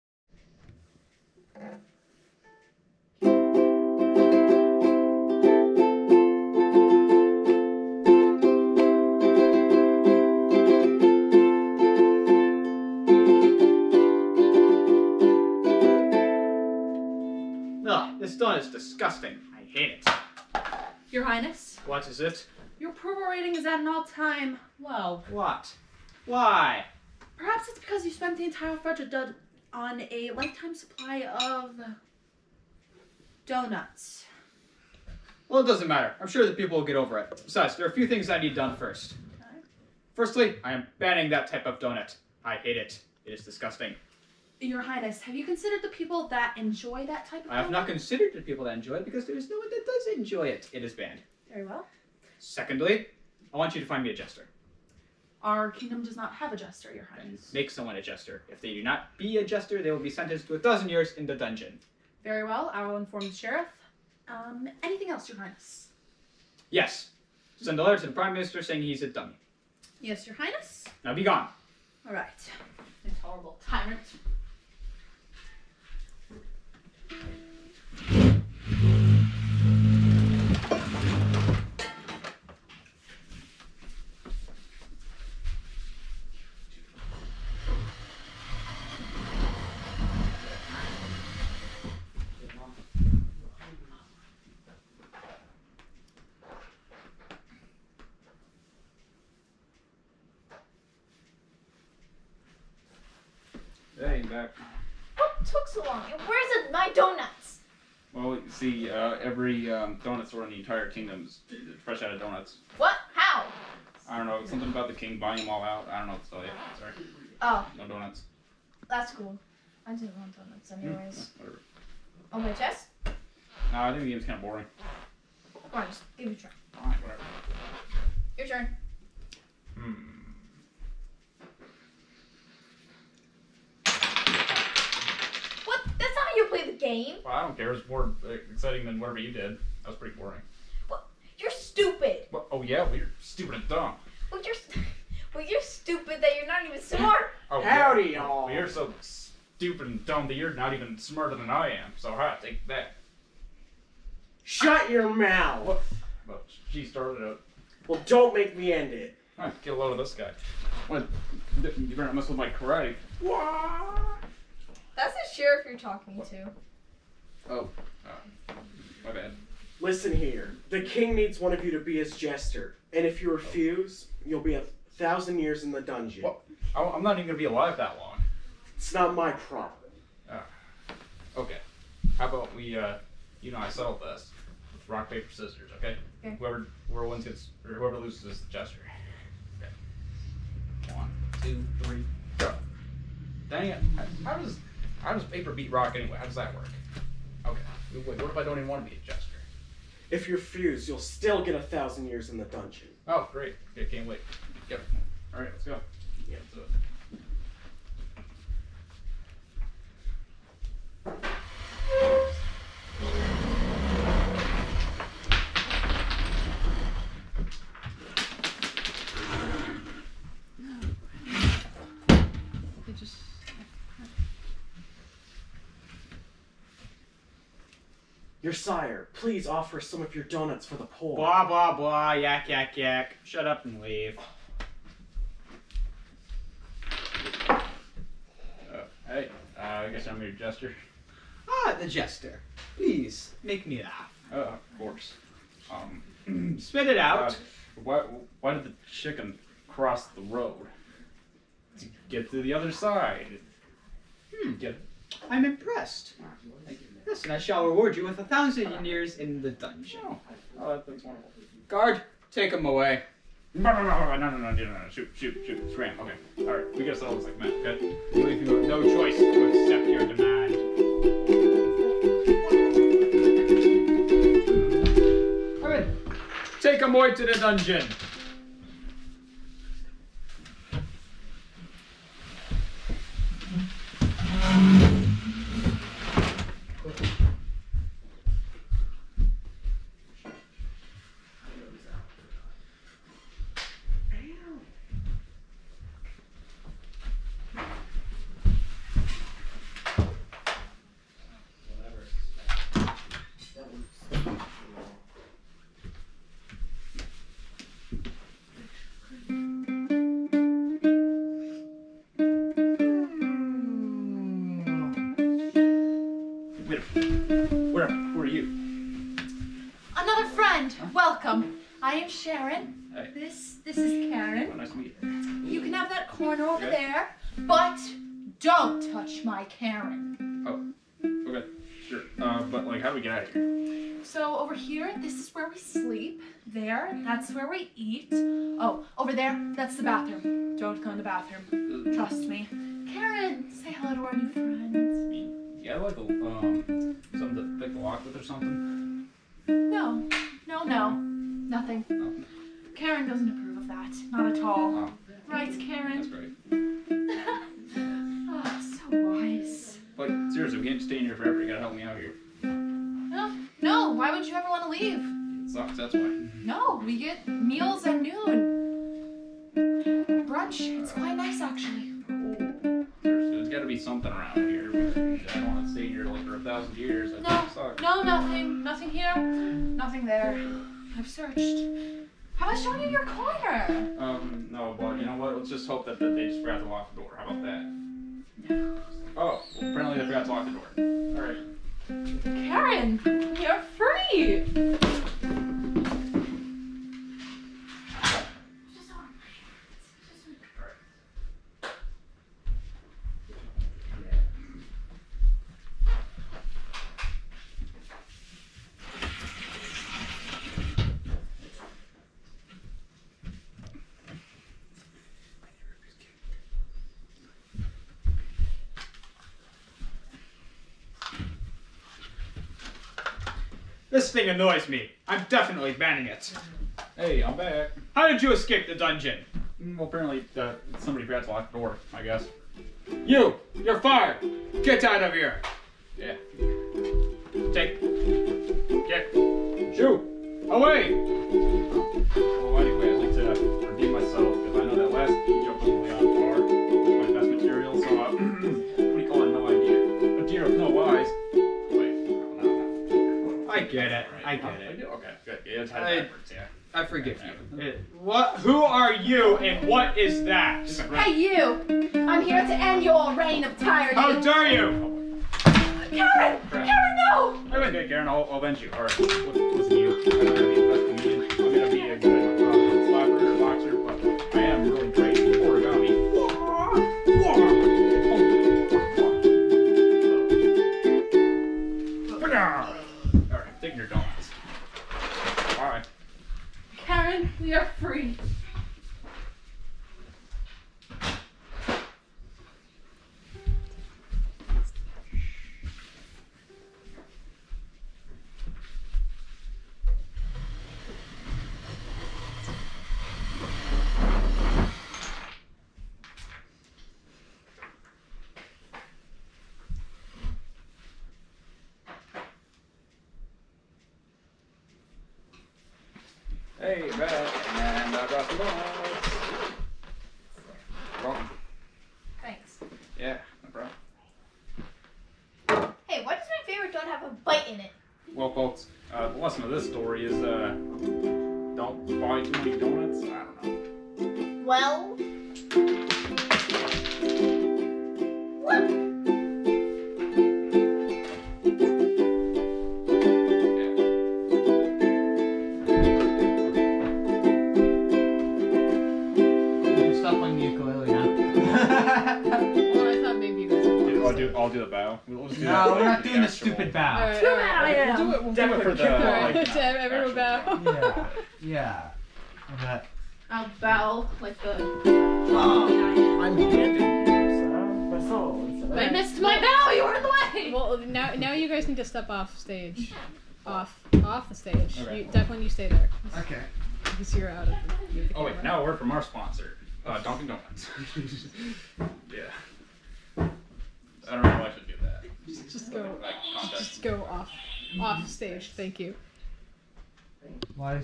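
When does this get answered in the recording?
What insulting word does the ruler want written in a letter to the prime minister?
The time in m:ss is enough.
1:09.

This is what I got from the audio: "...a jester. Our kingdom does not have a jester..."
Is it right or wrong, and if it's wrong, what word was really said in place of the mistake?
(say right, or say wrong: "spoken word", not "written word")
right.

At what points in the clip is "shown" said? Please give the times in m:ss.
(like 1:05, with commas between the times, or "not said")
6:22.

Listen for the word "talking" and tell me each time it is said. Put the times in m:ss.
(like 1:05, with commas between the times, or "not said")
2:45.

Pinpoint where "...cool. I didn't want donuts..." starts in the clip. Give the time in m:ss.
1:59.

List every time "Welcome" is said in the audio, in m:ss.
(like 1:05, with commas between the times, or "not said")
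5:20, 8:41.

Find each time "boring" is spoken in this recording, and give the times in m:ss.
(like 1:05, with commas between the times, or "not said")
2:04, 2:20.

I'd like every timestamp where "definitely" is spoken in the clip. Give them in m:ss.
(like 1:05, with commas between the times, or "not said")
7:05, 9:18.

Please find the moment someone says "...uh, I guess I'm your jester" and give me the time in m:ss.
3:59.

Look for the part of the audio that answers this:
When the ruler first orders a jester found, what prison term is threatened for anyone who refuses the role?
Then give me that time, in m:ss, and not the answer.
1:00.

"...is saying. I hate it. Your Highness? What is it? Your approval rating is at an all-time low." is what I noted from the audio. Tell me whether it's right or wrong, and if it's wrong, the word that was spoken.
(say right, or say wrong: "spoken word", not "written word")
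wrong: "disgusting", not "saying".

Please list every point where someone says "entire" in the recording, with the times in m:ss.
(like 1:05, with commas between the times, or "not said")
0:28, 1:50.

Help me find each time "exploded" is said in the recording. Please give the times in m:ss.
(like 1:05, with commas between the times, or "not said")
not said.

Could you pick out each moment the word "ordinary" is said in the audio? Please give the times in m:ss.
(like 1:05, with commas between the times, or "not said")
not said.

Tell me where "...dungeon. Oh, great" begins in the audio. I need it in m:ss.
3:22.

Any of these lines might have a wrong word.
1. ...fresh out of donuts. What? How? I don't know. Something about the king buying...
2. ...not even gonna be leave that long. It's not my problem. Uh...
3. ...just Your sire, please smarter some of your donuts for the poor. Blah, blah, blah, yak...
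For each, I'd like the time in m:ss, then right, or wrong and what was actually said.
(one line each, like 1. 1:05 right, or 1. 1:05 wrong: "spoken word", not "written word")
1. 1:51 right
2. 2:57 wrong: "alive", not "leave"
3. 3:42 wrong: "offer", not "smarter".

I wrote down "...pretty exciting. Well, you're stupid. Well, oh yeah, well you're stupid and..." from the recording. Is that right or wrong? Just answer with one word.
wrong.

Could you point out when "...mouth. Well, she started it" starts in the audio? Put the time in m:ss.
2:35.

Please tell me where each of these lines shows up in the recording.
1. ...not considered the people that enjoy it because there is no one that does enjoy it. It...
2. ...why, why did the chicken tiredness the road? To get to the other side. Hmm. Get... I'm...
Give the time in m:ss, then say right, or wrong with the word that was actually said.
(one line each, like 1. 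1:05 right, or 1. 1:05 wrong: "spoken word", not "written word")
1. 0:47 right
2. 4:07 wrong: "cross", not "tiredness".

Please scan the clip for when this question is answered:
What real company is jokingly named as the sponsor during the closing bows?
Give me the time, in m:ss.
9:40.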